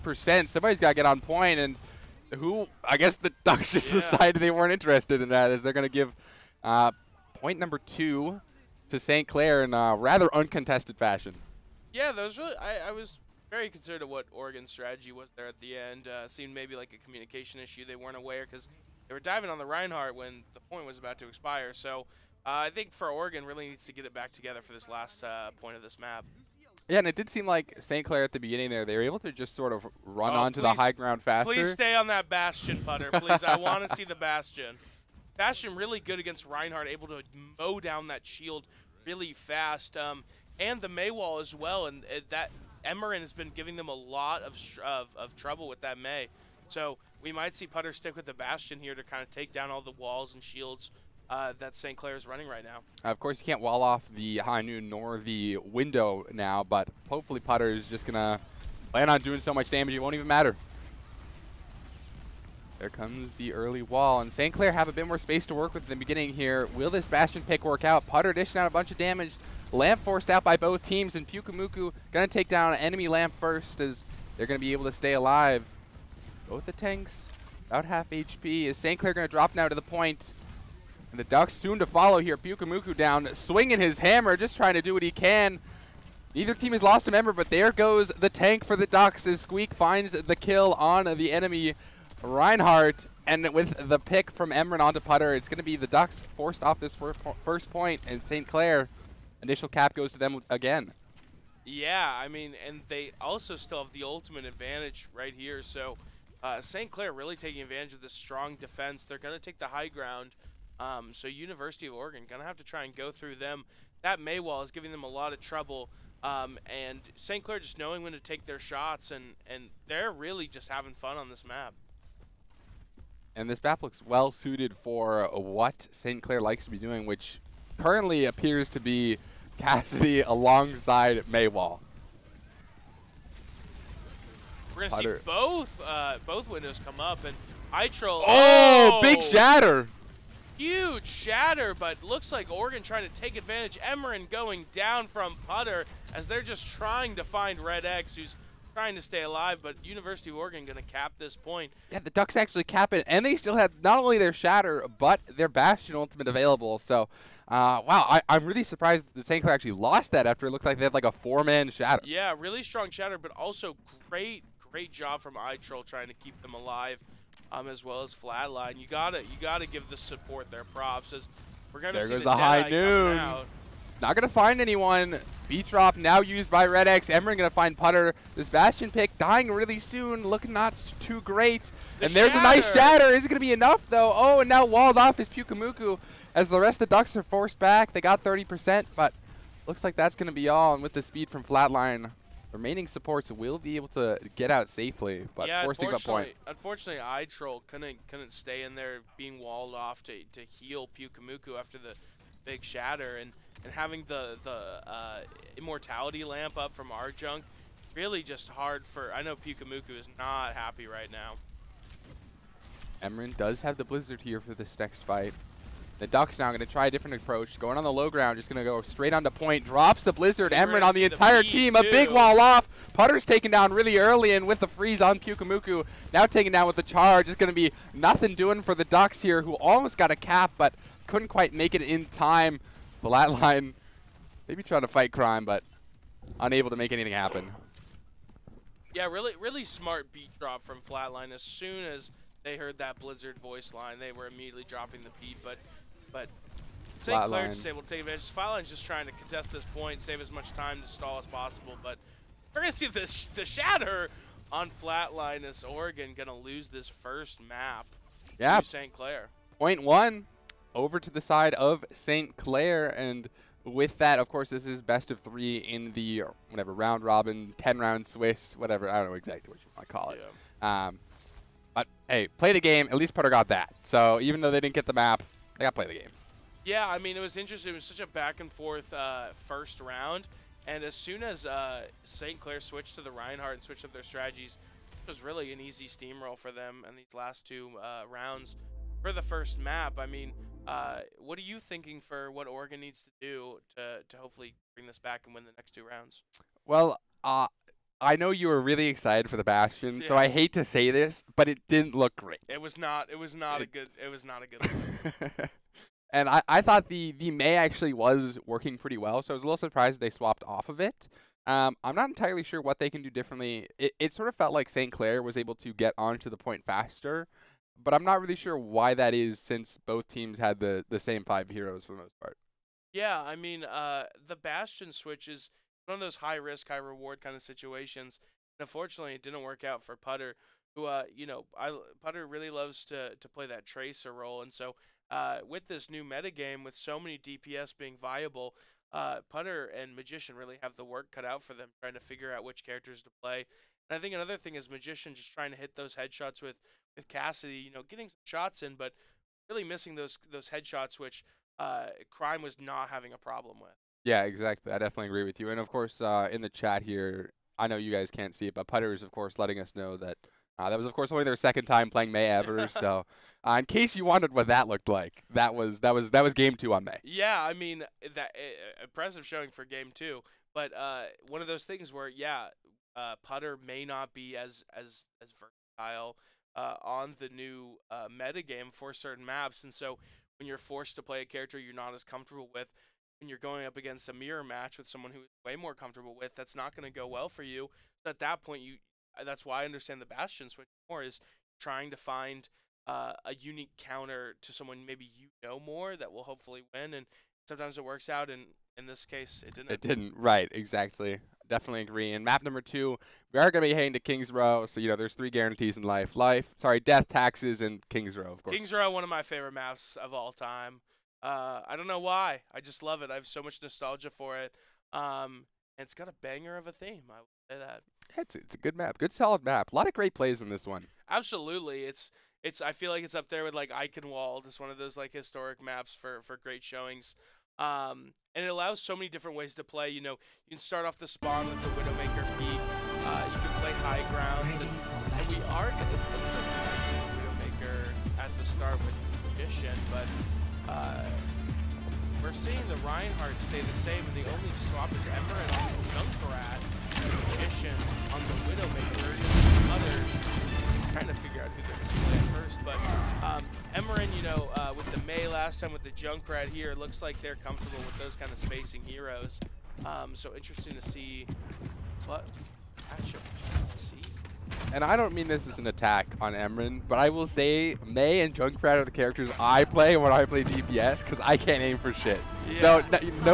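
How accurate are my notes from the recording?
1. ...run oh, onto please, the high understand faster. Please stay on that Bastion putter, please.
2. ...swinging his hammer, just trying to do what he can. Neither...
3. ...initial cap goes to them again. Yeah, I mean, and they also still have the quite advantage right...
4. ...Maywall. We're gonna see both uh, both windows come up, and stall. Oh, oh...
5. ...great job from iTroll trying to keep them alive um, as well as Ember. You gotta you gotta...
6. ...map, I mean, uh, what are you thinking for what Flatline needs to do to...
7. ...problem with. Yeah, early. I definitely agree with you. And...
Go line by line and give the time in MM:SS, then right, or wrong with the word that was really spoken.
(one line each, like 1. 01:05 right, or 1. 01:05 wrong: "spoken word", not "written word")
1. 00:30 wrong: "ground", not "understand"
2. 01:23 right
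3. 01:39 wrong: "ultimate", not "quite"
4. 02:11 wrong: "iTroll", not "stall"
5. 02:44 wrong: "Flatline", not "Ember"
6. 04:49 wrong: "Oregon", not "Flatline"
7. 05:53 wrong: "exactly", not "early".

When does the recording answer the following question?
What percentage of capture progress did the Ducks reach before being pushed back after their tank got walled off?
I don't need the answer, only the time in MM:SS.
03:08.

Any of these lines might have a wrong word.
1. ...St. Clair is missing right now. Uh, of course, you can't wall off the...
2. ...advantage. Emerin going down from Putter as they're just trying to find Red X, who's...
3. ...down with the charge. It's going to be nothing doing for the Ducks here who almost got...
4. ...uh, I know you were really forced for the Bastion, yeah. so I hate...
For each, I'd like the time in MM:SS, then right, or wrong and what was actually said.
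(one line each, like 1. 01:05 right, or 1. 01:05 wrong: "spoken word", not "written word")
1. 00:51 wrong: "running", not "missing"
2. 02:23 right
3. 03:46 right
4. 04:57 wrong: "excited", not "forced".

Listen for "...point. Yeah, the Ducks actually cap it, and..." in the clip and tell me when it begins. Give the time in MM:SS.
02:31.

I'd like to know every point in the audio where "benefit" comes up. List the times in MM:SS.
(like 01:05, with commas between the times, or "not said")
not said.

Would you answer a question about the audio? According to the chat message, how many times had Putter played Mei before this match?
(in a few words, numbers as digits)
2.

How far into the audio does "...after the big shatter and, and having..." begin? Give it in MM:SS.
03:21.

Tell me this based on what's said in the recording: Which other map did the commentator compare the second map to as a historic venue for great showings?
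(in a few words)
Eichenwalde.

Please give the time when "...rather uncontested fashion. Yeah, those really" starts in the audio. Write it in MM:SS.
00:09.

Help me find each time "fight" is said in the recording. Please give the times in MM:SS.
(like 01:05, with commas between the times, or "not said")
03:35, 03:54.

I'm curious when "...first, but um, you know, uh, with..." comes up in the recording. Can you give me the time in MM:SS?
07:32.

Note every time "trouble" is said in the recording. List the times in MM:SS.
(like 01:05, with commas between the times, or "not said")
00:45, 01:55.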